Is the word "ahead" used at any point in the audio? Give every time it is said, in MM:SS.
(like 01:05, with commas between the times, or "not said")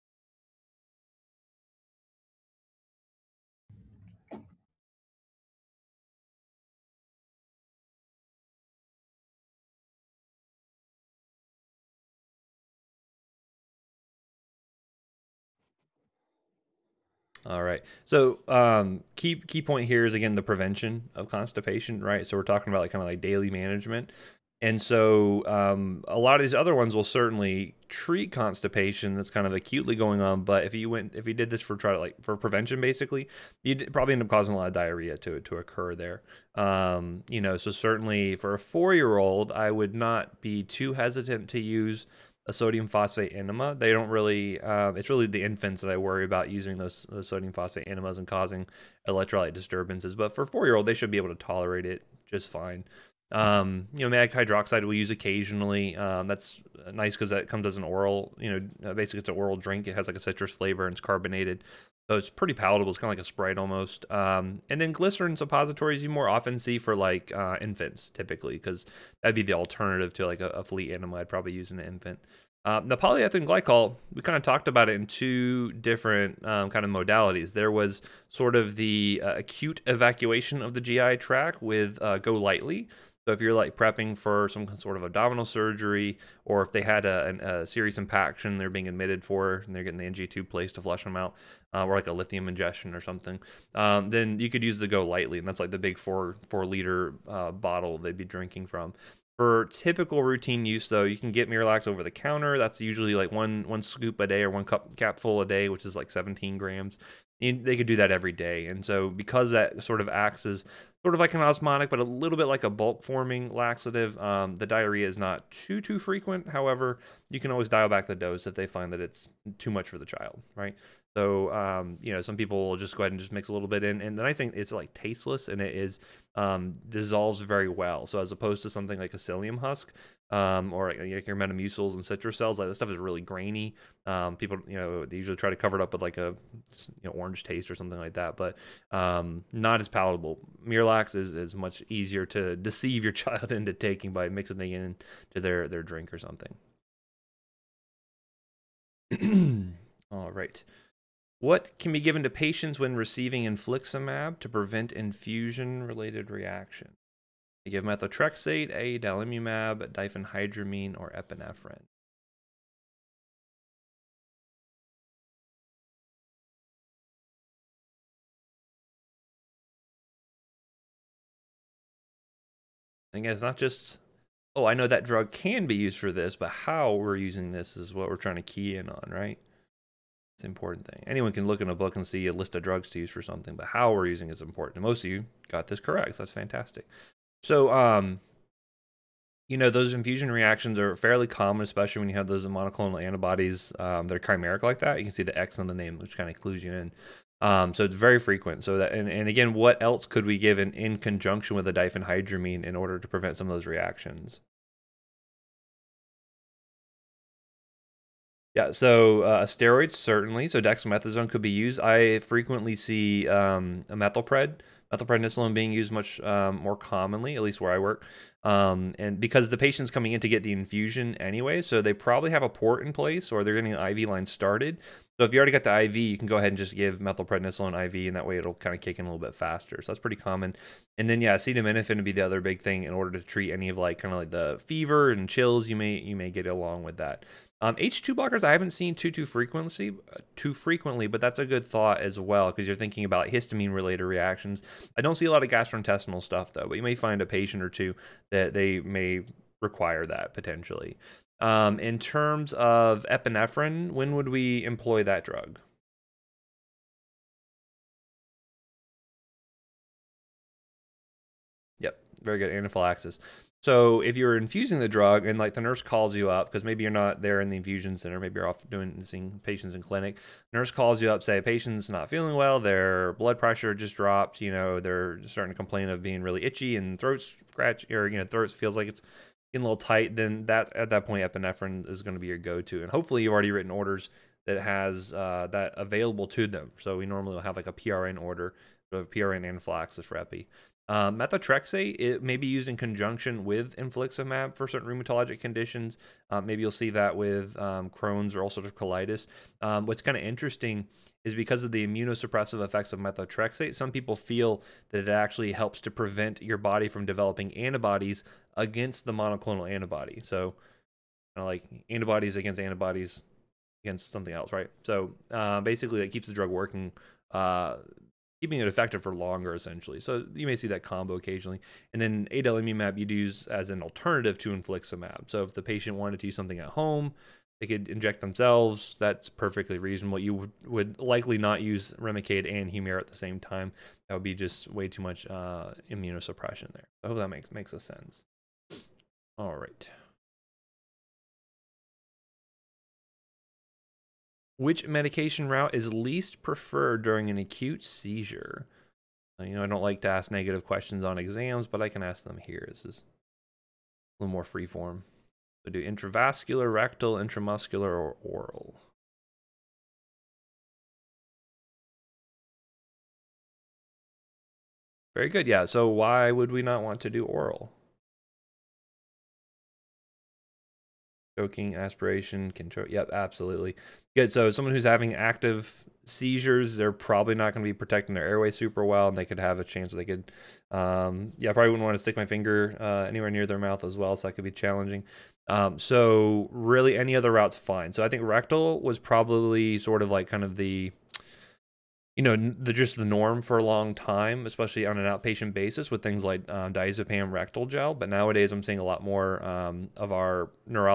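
02:03, 03:46.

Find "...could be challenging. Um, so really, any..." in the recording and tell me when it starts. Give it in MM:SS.
06:24.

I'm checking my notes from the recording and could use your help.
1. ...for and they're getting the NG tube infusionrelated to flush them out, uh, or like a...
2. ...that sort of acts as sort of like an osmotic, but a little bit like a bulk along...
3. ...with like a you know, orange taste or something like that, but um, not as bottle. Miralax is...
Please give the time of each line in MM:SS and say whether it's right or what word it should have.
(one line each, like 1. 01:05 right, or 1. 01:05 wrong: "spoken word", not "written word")
1. 01:29 wrong: "placed", not "infusionrelated"
2. 01:49 wrong: "forming", not "along"
3. 02:15 wrong: "palatable", not "bottle".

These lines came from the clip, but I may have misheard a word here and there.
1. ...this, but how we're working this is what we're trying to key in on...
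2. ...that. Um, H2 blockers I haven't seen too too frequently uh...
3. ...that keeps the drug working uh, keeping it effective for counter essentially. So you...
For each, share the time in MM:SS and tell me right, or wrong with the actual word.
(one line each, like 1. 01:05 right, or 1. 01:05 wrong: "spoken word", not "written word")
1. 02:56 wrong: "using", not "working"
2. 03:56 right
3. 05:16 wrong: "longer", not "counter".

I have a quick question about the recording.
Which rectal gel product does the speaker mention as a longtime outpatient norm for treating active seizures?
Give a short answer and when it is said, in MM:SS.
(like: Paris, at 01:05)
Diazepam rectal gel, at 06:36.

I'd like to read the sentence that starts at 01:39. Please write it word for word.
For typical routine use, though, you can get Miralax over the counter.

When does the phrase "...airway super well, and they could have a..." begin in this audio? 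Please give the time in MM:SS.
06:18.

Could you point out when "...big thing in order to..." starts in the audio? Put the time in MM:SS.
03:52.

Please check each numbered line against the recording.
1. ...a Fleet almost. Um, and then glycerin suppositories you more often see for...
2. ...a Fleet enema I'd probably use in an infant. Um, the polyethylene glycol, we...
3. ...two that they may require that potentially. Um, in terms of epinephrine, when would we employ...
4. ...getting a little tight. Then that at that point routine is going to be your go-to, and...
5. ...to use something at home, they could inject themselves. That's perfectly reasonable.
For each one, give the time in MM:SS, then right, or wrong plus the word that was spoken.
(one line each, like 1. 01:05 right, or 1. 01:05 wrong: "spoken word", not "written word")
1. 01:03 wrong: "Sprite", not "Fleet"
2. 01:10 right
3. 04:07 right
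4. 04:39 wrong: "epinephrine", not "routine"
5. 05:26 right.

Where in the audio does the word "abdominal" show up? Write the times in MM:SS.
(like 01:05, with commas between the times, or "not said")
01:25.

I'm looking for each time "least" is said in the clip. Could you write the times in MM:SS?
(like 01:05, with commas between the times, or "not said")
03:37, 05:45.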